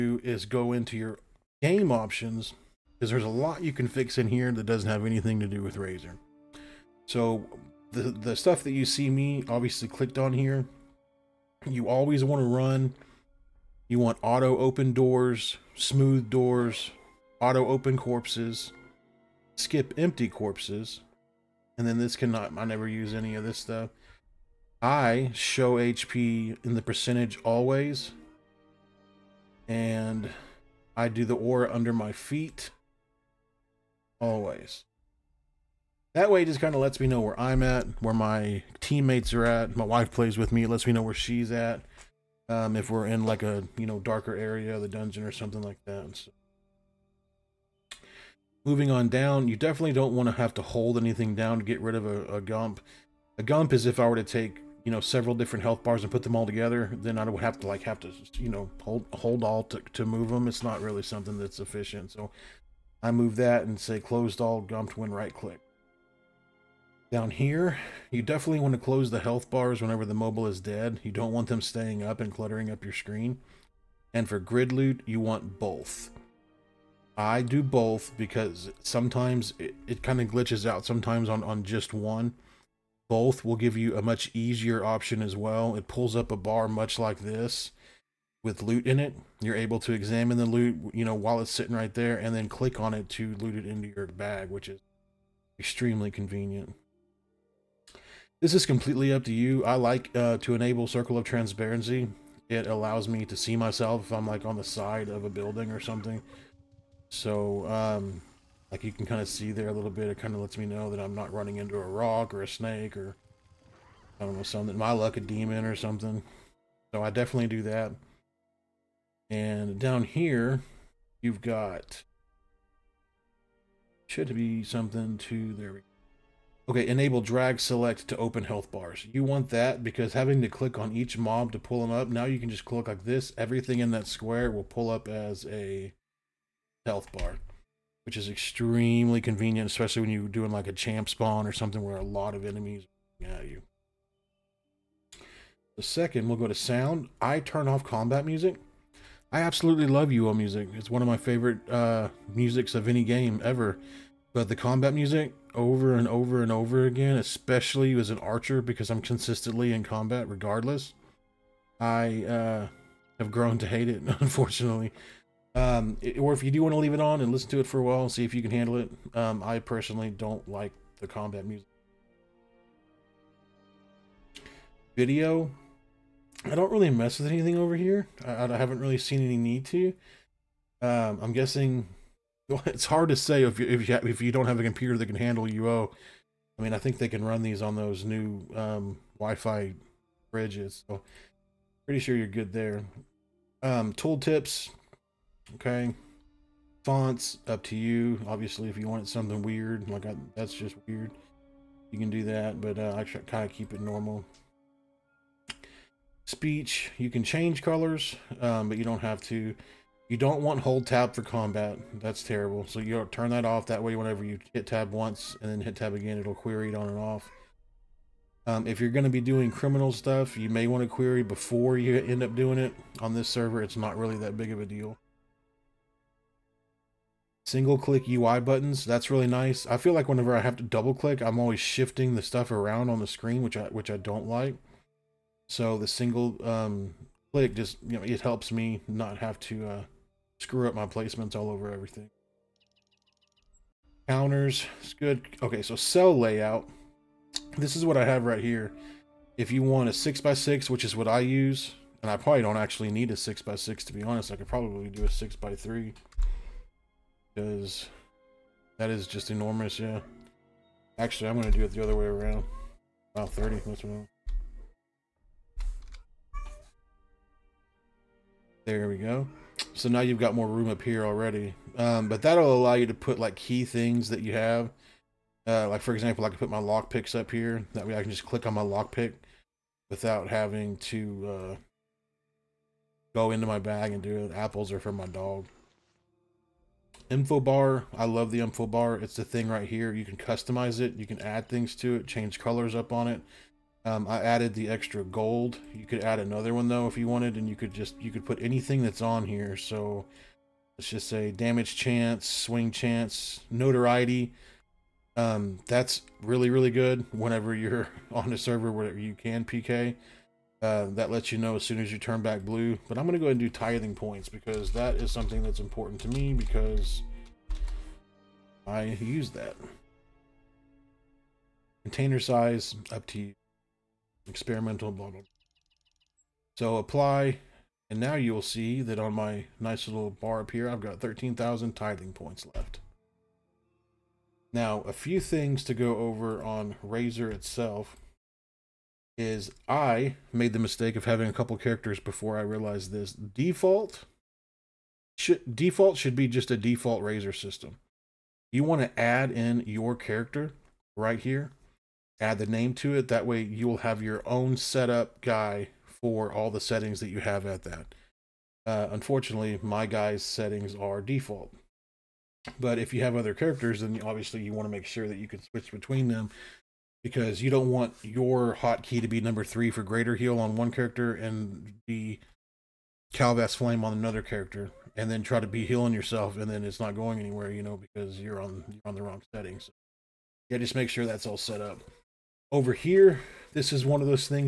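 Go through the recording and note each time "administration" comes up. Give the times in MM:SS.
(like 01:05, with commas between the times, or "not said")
not said.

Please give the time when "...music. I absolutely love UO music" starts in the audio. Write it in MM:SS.
02:28.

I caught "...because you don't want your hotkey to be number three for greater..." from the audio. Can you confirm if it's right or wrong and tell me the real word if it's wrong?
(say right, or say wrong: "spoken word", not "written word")
right.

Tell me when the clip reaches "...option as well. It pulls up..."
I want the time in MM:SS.
01:24.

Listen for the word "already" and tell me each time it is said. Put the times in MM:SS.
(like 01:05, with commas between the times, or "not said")
04:31.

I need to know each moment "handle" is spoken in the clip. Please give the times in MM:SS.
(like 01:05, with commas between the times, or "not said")
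02:48, 03:05.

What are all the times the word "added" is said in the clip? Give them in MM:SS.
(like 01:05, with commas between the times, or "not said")
04:54.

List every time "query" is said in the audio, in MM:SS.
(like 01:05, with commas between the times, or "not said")
03:36, 03:40.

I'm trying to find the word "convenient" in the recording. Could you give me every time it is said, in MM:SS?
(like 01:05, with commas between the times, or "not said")
01:36, 02:19.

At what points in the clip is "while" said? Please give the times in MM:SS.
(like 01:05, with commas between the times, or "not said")
01:31, 02:47.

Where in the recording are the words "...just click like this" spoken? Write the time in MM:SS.
02:12.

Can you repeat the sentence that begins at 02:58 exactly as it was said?
I, I haven't really seen any need to.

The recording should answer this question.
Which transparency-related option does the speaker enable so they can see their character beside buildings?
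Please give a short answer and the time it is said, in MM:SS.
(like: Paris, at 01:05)
circle of transparency, at 01:40.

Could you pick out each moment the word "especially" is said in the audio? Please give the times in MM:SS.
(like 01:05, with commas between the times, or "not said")
02:19, 02:37.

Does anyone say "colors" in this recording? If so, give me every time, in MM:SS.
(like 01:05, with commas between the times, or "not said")
03:27, 04:52.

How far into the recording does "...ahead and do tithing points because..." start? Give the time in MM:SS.
05:13.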